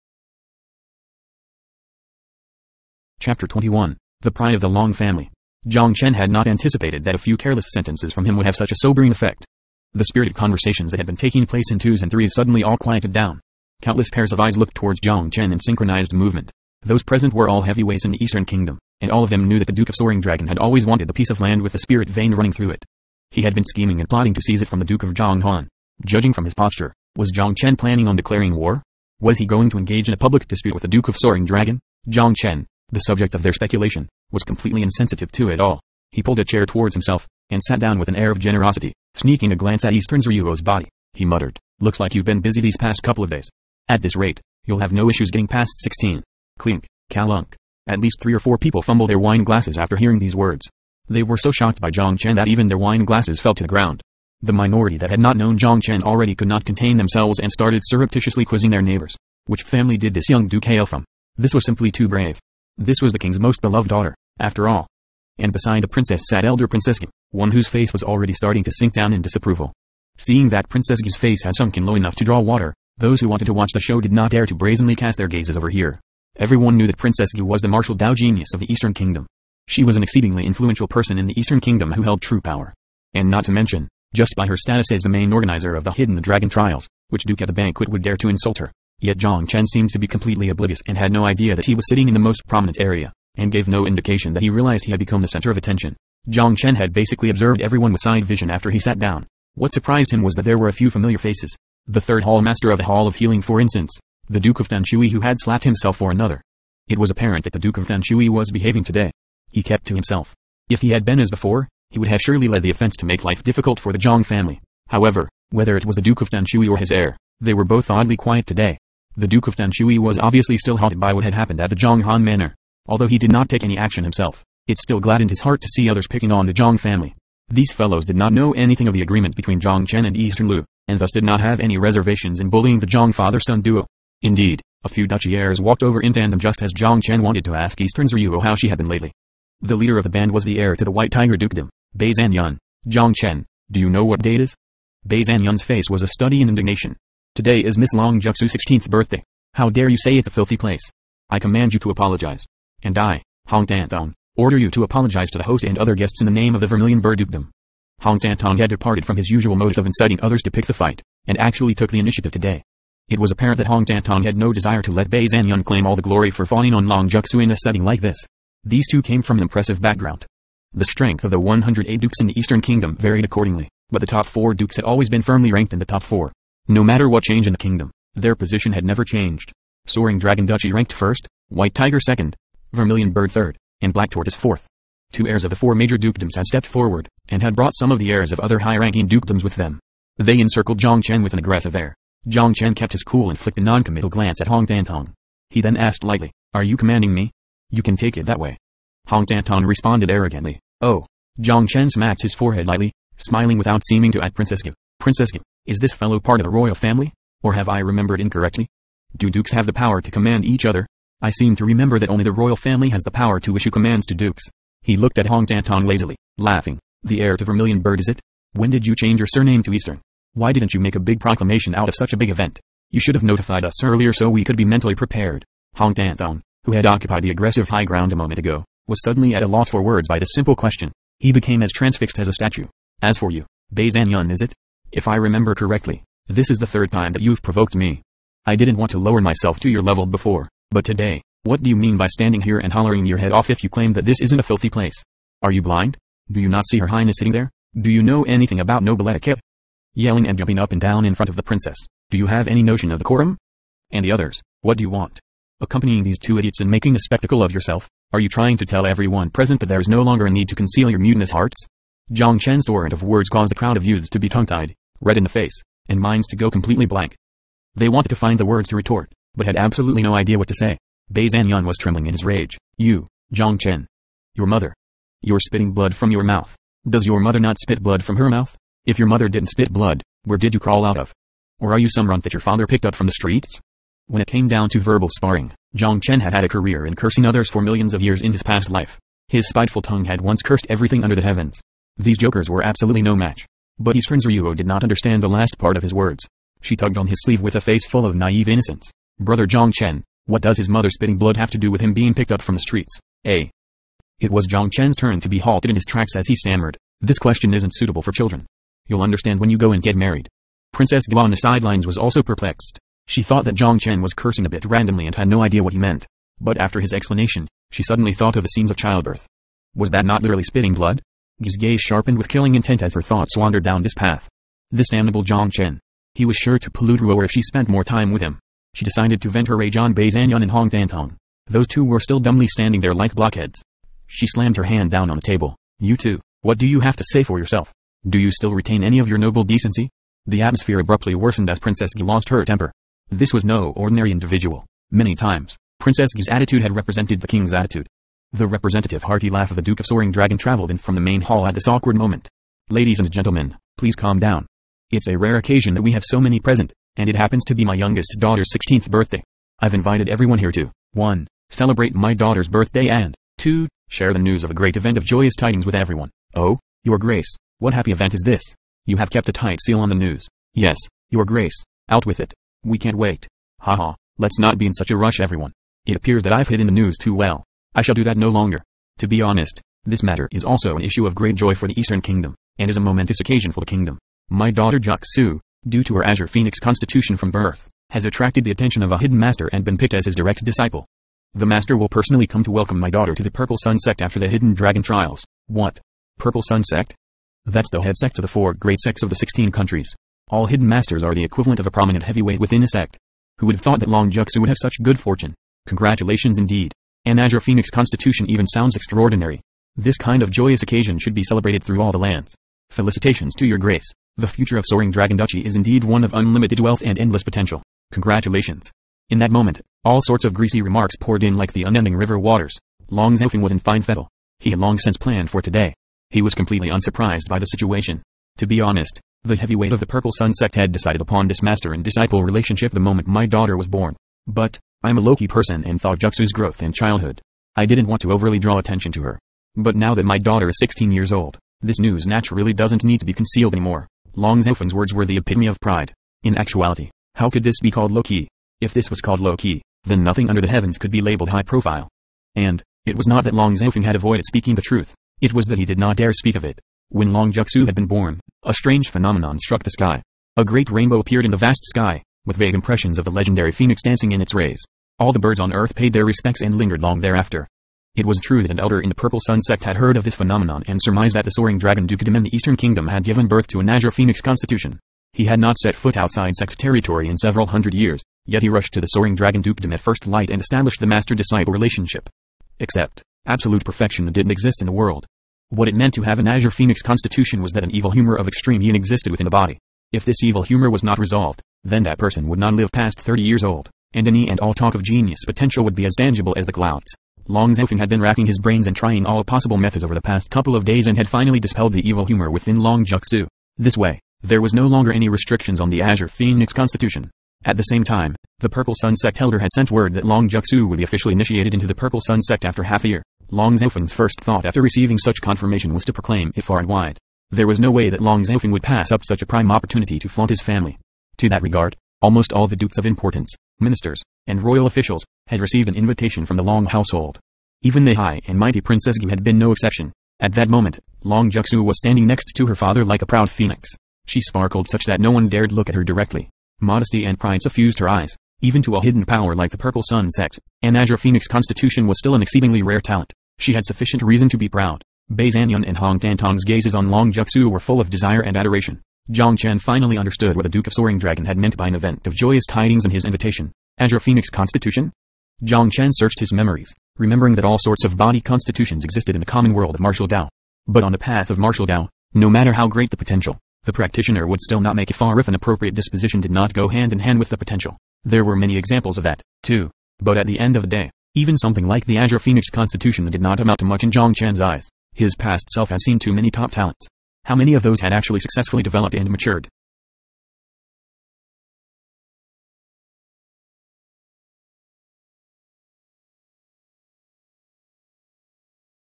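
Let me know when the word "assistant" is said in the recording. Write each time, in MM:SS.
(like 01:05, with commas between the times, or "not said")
not said.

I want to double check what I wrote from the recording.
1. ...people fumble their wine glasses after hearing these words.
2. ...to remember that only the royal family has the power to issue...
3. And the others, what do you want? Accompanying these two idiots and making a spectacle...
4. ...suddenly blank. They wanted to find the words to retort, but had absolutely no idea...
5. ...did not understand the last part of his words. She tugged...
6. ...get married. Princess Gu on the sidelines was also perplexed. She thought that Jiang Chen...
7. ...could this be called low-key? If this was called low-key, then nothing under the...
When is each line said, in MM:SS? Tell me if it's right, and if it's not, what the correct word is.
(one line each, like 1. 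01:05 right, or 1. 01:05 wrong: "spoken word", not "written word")
1. 00:48 right
2. 03:31 right
3. 04:13 right
4. 04:26 wrong: "completely", not "suddenly"
5. 04:54 right
6. 05:09 right
7. 07:27 right.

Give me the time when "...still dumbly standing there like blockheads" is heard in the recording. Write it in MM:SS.
05:31.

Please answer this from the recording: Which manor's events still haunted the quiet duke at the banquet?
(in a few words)
Zhonghan Manor.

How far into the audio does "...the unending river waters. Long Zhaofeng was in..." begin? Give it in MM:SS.
07:01.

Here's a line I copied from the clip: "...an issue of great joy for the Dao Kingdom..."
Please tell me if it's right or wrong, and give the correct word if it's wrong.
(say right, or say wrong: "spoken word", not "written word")
wrong: "Eastern", not "Dao".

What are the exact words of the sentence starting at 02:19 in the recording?
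The leader of the band was the heir to the White Tiger Dukedom, Bei Zanyun.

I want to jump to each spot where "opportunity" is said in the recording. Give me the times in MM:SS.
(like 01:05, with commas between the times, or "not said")
08:39.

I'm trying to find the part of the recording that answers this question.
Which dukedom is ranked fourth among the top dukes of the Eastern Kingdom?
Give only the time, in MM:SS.
03:03.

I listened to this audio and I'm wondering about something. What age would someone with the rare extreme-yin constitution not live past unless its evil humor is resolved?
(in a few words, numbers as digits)
30.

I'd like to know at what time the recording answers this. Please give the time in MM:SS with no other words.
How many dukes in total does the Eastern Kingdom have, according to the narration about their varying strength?
02:51.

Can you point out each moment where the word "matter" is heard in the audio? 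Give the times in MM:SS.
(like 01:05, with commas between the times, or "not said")
02:56, 06:20, 09:22.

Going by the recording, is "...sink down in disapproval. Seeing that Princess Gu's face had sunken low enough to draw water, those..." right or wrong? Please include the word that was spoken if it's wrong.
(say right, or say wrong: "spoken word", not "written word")
right.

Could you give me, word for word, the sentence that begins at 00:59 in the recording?
Which family did this young duke hail from?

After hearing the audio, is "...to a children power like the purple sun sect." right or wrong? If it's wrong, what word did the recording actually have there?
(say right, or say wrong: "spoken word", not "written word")
wrong: "hidden", not "children".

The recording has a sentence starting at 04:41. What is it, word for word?
Or are you some runt that your father picked up from the streets?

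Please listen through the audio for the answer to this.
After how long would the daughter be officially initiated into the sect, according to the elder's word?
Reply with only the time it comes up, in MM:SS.
08:32.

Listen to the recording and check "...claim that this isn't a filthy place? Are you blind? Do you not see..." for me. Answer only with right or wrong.
right.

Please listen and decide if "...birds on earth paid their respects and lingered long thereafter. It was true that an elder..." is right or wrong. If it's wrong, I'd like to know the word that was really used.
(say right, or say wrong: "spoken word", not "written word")
right.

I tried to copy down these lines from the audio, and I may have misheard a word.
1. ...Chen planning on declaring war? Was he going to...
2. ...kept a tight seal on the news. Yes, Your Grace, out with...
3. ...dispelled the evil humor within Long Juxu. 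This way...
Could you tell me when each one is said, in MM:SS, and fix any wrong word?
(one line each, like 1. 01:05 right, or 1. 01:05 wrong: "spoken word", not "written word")
1. 00:27 right
2. 06:09 right
3. 08:21 right.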